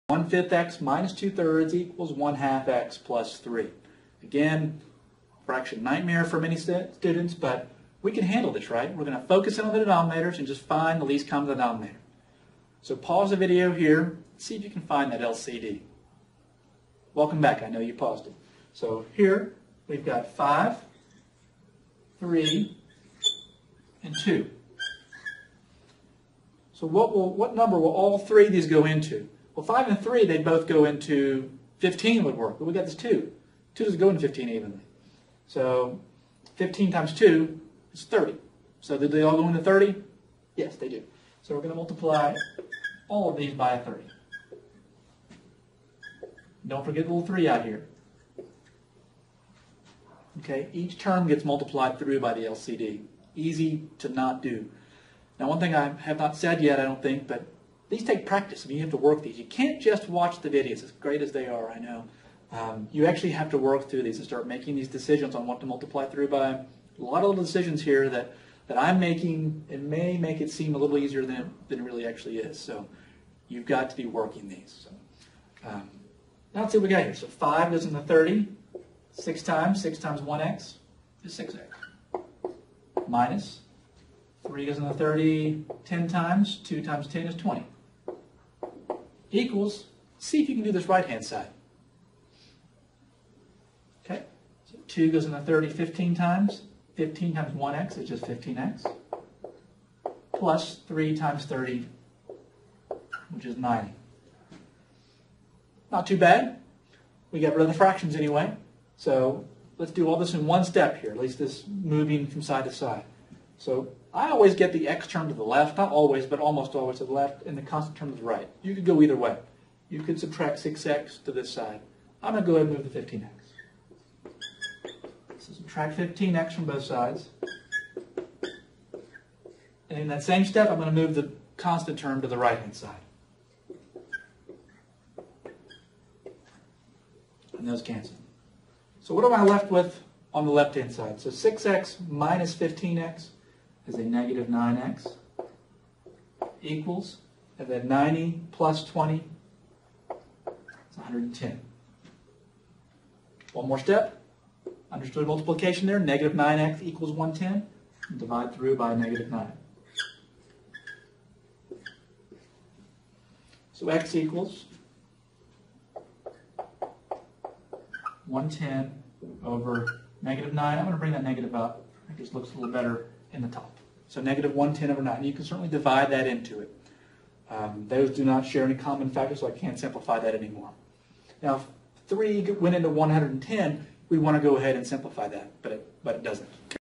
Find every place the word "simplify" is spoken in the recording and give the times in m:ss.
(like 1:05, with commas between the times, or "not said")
2:59, 3:04.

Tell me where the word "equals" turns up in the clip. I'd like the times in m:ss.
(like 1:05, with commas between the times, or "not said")
0:01, 1:29, 2:26, 2:36, 2:44.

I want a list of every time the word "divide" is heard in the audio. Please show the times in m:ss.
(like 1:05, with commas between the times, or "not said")
2:38, 2:55.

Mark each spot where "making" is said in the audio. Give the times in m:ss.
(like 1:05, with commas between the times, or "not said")
1:04, 1:08.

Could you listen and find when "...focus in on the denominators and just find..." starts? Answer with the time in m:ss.
0:09.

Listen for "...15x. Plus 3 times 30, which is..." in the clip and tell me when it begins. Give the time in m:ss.
1:38.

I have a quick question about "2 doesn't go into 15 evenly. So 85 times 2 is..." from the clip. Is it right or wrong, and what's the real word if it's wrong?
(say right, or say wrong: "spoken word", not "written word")
wrong: "15", not "85".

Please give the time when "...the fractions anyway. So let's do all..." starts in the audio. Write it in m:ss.
1:47.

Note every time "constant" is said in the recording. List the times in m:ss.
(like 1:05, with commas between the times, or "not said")
1:57, 2:11.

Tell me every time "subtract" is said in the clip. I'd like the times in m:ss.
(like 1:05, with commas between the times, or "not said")
2:00, 2:05.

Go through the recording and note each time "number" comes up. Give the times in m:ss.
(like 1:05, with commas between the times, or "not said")
0:27.